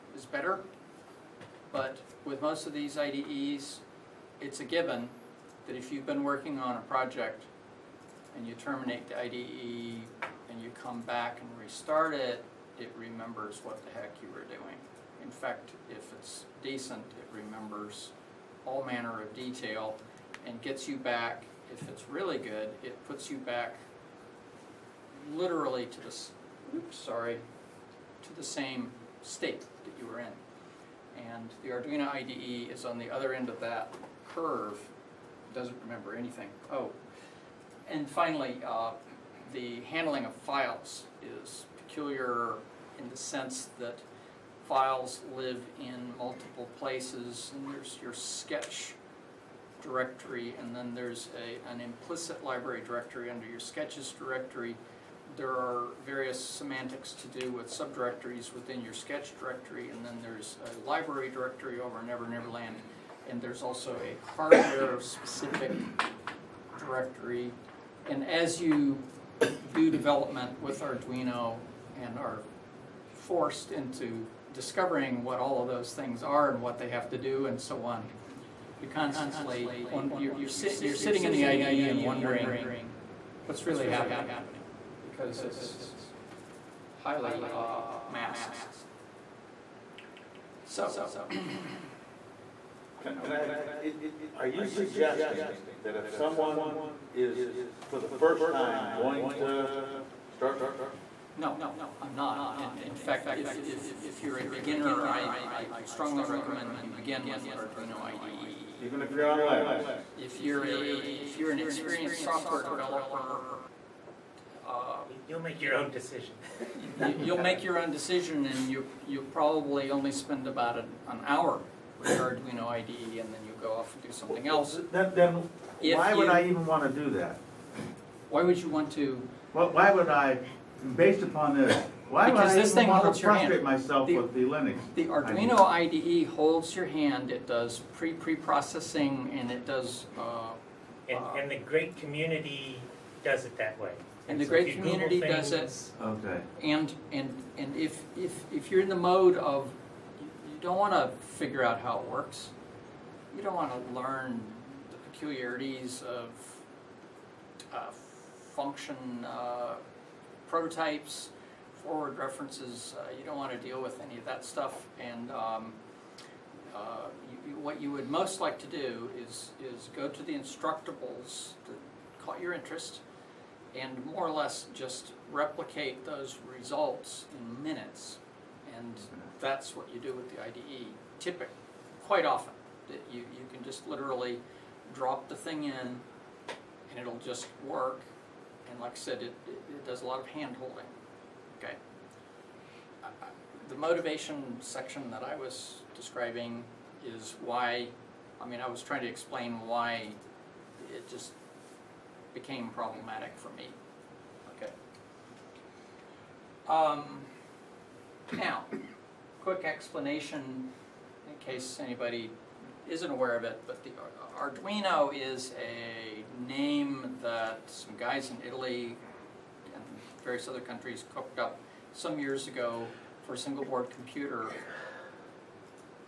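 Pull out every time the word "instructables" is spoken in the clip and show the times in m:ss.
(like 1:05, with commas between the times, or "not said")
2:50.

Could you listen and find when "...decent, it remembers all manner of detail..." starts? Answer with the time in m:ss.
0:16.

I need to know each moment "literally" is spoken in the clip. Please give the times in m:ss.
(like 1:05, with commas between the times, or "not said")
0:25, 3:03.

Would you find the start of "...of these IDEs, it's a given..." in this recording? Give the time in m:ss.
0:02.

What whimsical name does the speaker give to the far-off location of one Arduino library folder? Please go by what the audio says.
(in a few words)
Never Never Land.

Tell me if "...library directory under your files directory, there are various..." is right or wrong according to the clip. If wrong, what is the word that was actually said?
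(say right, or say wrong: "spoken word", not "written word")
wrong: "sketches", not "files".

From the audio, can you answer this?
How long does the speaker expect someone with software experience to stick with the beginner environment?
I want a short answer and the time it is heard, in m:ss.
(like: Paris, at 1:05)
an hour, at 2:01.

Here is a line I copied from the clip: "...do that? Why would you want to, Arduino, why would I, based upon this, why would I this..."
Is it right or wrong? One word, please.
wrong.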